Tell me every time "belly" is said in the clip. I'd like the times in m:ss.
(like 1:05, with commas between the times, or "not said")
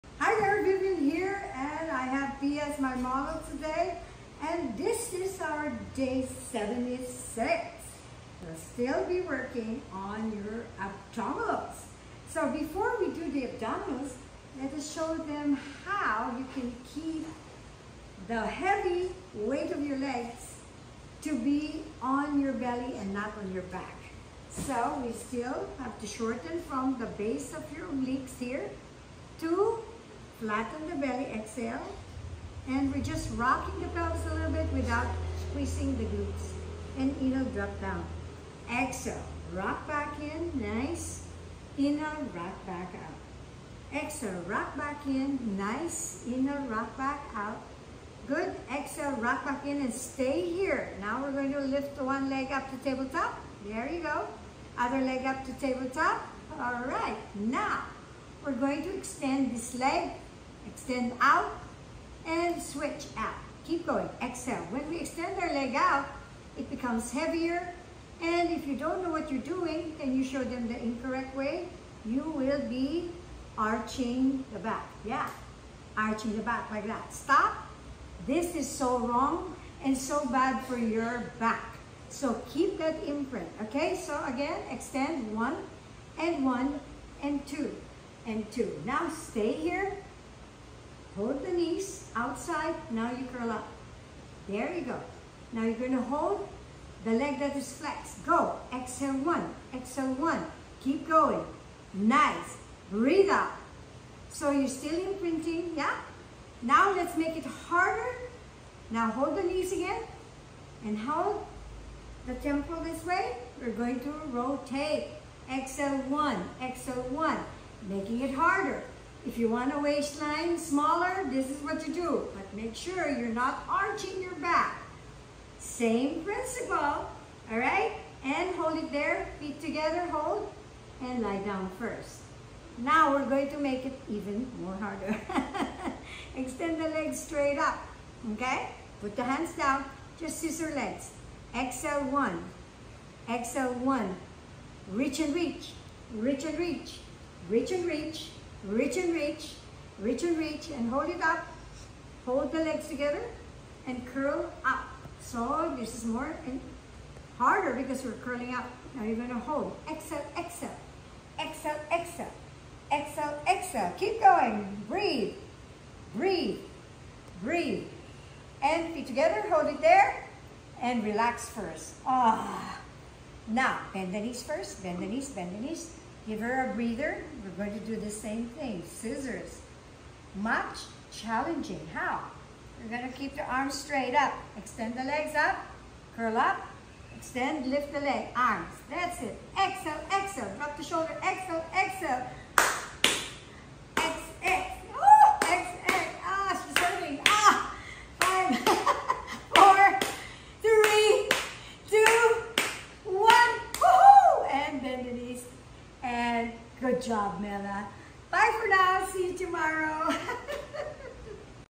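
0:22, 0:30.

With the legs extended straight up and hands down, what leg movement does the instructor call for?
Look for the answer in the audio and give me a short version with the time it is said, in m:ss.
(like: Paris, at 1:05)
scissor legs, at 2:20.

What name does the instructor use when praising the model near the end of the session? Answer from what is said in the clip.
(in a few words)
Mela.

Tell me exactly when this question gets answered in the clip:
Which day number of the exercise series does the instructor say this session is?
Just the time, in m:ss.
0:05.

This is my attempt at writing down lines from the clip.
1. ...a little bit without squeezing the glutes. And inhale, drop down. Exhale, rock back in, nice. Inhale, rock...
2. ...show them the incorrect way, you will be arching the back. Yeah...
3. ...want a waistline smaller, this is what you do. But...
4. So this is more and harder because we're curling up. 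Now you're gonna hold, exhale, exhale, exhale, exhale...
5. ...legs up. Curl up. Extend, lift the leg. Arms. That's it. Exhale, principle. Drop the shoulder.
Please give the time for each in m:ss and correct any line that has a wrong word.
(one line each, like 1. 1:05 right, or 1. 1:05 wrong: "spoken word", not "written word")
1. 0:34 right
2. 1:10 right
3. 1:59 right
4. 2:35 right
5. 3:05 wrong: "exhale", not "principle".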